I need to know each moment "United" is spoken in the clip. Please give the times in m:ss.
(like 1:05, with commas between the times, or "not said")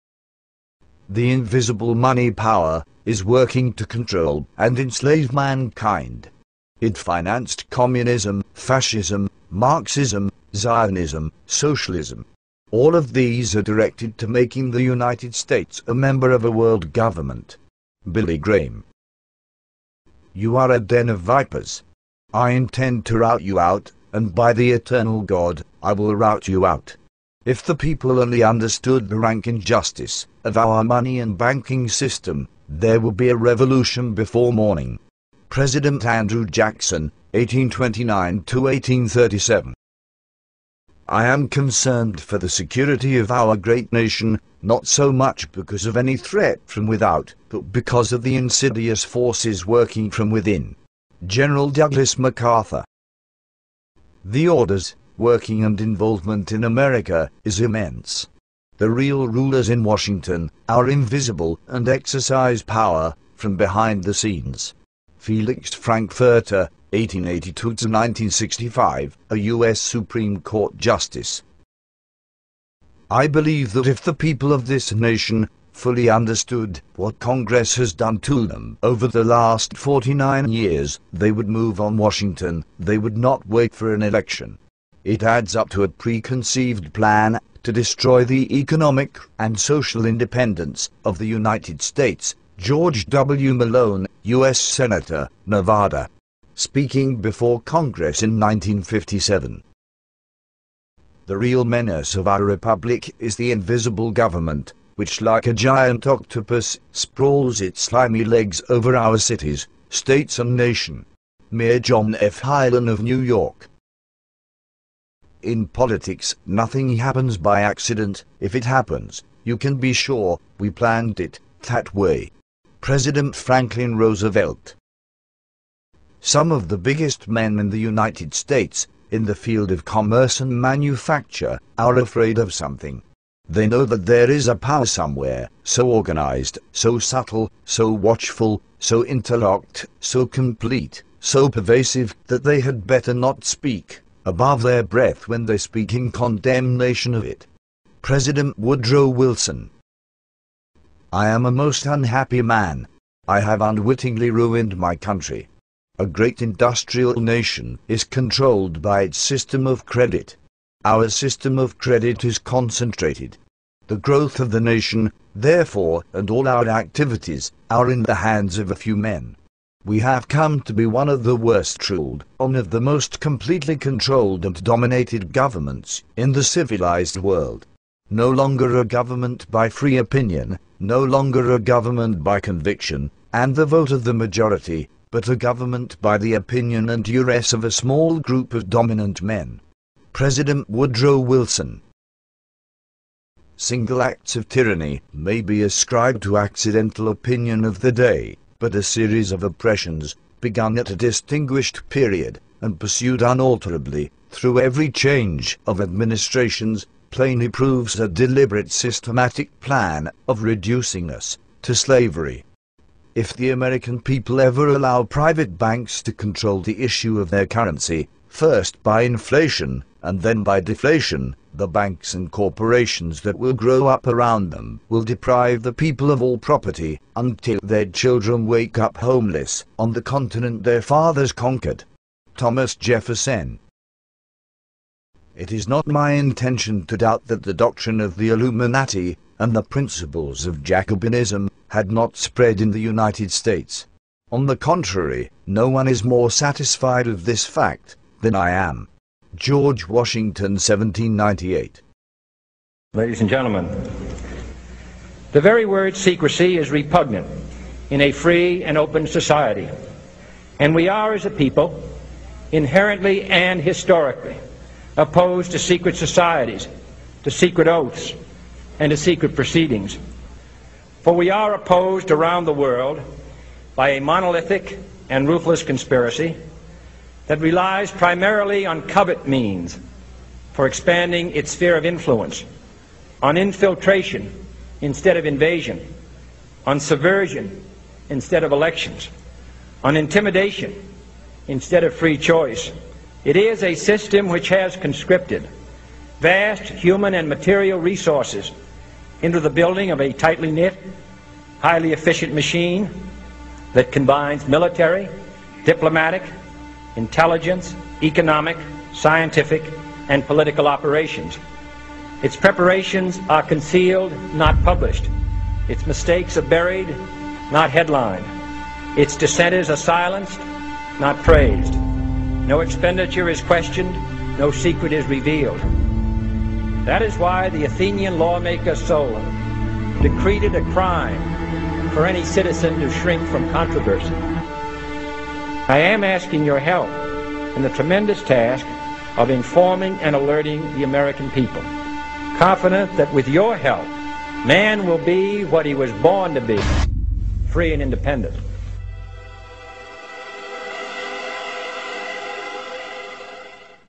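0:14, 1:31, 2:07, 4:02.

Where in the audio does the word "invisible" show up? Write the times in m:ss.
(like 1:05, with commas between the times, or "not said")
0:01, 1:00, 1:43.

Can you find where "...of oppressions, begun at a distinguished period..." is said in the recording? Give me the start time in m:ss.
3:19.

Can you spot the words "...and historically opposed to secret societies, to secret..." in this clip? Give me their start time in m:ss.
4:23.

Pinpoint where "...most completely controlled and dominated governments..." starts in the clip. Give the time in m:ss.
2:52.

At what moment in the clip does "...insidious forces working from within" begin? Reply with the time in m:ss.
0:48.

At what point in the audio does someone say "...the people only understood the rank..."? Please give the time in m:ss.
0:27.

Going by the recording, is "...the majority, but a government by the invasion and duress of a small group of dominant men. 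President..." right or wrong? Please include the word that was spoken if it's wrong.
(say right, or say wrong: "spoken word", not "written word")
wrong: "opinion", not "invasion".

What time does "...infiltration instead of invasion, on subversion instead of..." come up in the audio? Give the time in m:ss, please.
4:43.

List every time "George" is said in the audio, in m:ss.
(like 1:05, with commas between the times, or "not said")
1:32, 4:09.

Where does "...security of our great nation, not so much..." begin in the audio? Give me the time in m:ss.
0:42.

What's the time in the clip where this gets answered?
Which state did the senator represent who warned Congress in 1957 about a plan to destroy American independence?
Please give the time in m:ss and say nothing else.
1:35.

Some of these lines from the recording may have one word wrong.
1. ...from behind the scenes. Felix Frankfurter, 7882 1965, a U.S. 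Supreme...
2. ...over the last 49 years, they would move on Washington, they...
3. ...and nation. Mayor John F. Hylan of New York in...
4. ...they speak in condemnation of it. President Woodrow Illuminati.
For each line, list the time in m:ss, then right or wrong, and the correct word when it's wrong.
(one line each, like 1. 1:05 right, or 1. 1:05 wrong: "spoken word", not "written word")
1. 1:03 wrong: "1882", not "7882"
2. 1:18 right
3. 1:50 right
4. 2:25 wrong: "Wilson", not "Illuminati".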